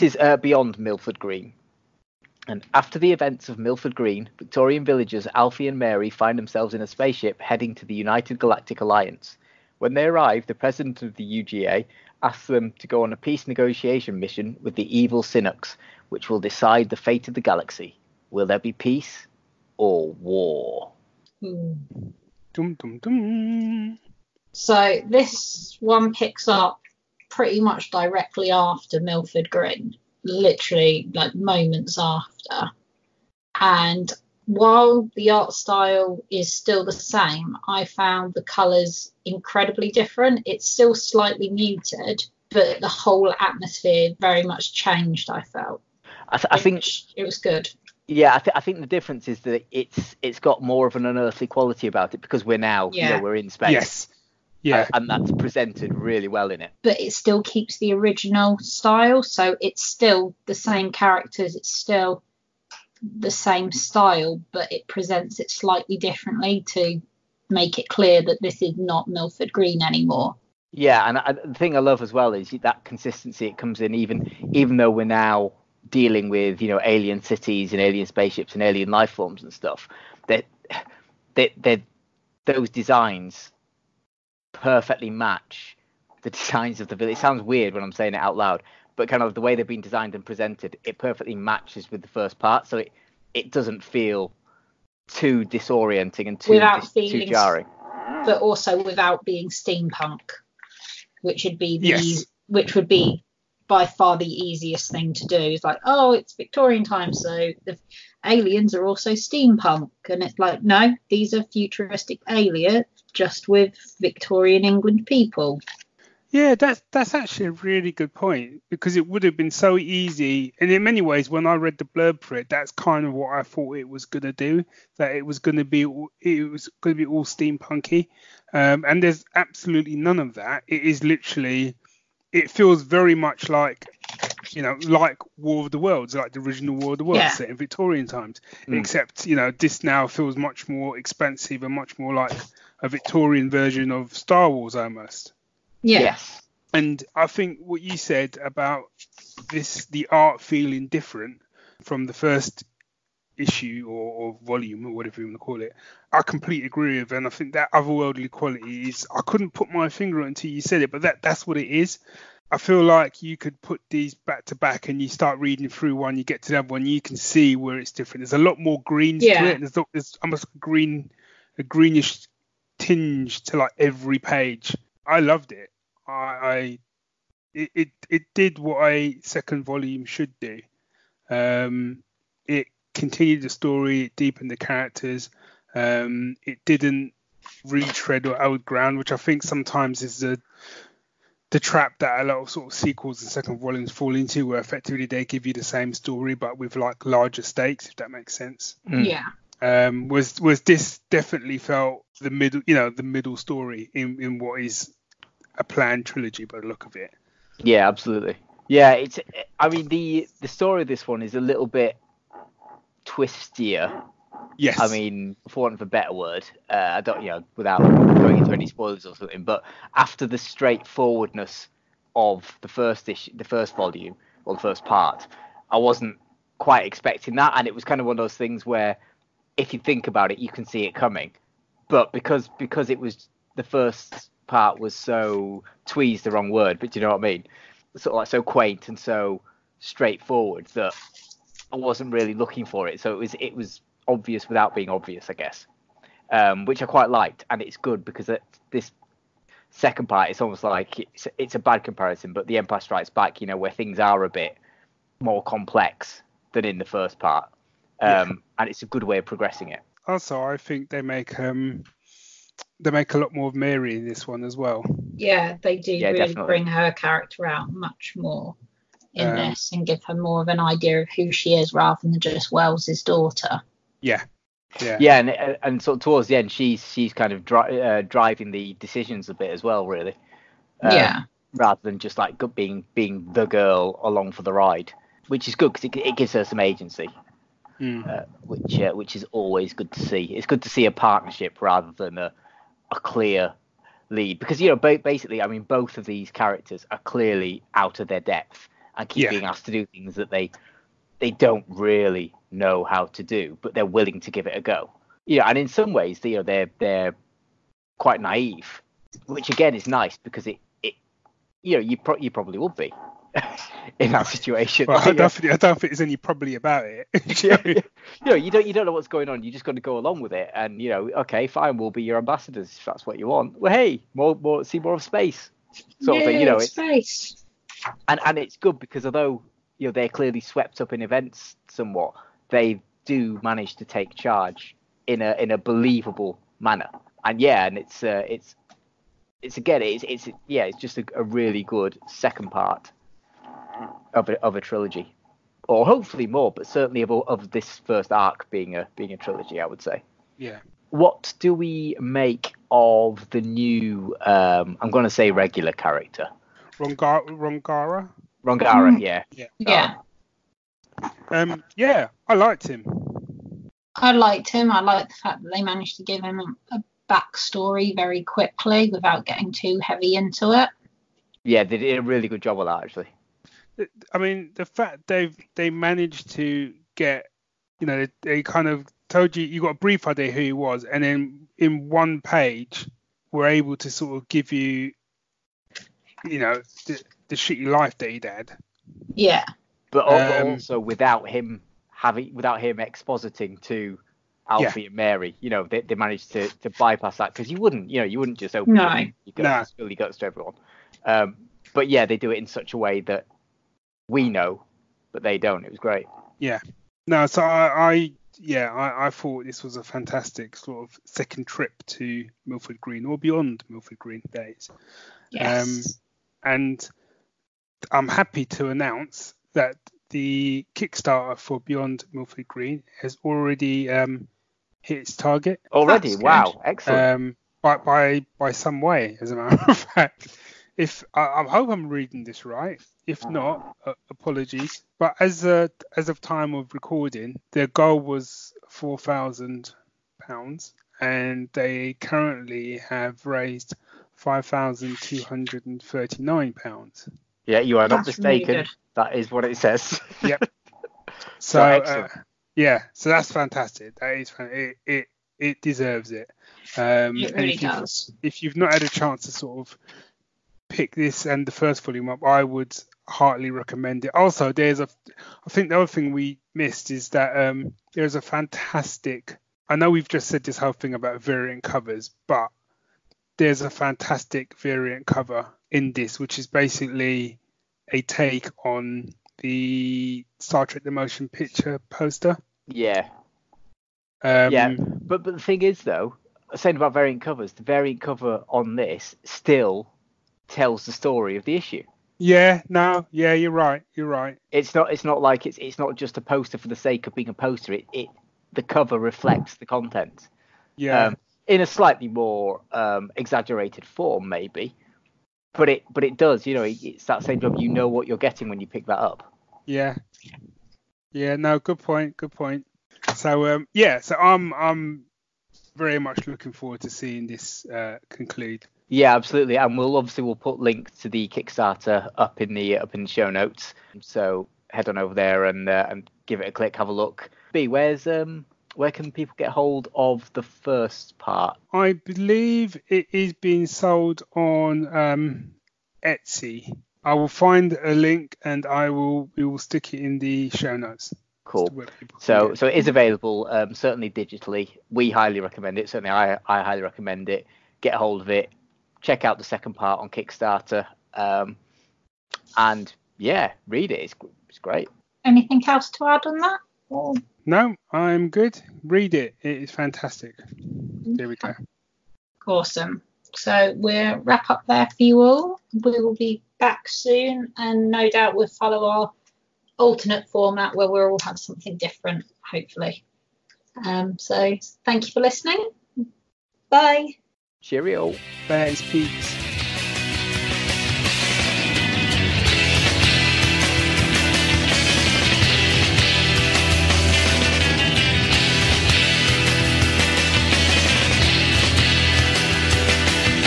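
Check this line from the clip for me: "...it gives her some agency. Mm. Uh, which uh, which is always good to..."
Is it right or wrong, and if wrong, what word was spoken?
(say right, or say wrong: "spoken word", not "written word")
right.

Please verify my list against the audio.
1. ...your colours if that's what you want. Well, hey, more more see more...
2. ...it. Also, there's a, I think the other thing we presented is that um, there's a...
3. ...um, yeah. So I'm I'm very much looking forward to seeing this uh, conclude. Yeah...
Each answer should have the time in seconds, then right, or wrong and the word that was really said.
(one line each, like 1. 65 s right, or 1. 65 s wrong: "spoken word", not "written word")
1. 322 s wrong: "ambassadors", not "colours"
2. 464 s wrong: "missed", not "presented"
3. 513 s right.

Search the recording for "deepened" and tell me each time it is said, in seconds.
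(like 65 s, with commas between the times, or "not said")
184 s.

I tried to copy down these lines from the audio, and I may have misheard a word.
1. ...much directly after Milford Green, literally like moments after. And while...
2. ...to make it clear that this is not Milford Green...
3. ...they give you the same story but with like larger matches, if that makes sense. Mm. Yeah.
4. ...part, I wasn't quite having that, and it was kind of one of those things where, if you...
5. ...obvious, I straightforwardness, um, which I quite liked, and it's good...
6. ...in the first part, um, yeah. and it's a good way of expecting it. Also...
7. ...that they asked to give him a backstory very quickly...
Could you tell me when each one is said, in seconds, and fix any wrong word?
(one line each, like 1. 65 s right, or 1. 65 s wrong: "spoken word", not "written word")
1. 27 s right
2. 66 s right
3. 195 s wrong: "stakes", not "matches"
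4. 224 s wrong: "expecting", not "having"
5. 244 s wrong: "guess", not "straightforwardness"
6. 256 s wrong: "progressing", not "expecting"
7. 365 s wrong: "managed", not "asked".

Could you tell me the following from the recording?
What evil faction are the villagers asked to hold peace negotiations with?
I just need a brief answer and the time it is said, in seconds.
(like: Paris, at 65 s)
Sinux, at 15 s.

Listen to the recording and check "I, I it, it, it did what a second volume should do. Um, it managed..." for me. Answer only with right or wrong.
wrong.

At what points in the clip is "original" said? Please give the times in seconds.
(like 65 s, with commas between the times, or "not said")
57 s, 136 s.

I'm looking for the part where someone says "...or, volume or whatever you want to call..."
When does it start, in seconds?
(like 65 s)
154 s.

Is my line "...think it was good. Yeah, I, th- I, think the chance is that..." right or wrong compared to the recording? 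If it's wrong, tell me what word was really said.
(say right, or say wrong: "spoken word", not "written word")
wrong: "difference", not "chance".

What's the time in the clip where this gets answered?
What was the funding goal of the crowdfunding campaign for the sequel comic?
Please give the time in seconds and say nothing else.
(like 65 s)
438 s.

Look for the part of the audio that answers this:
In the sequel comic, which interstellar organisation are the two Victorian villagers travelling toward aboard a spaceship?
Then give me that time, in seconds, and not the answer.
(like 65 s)
7 s.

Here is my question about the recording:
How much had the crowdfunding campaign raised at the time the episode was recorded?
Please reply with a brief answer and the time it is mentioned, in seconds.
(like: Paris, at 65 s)
£5,239, at 444 s.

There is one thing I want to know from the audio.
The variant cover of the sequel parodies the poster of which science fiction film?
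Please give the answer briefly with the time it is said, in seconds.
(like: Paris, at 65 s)
Star Trek the Motion Picture, at 480 s.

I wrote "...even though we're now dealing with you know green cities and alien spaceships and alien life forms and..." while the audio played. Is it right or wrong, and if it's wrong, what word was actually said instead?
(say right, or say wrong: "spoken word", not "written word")
wrong: "alien", not "green".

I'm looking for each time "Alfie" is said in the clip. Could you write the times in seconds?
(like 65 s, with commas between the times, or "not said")
5 s, 394 s.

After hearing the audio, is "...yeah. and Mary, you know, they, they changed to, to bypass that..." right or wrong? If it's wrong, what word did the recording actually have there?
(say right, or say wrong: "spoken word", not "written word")
wrong: "managed", not "changed".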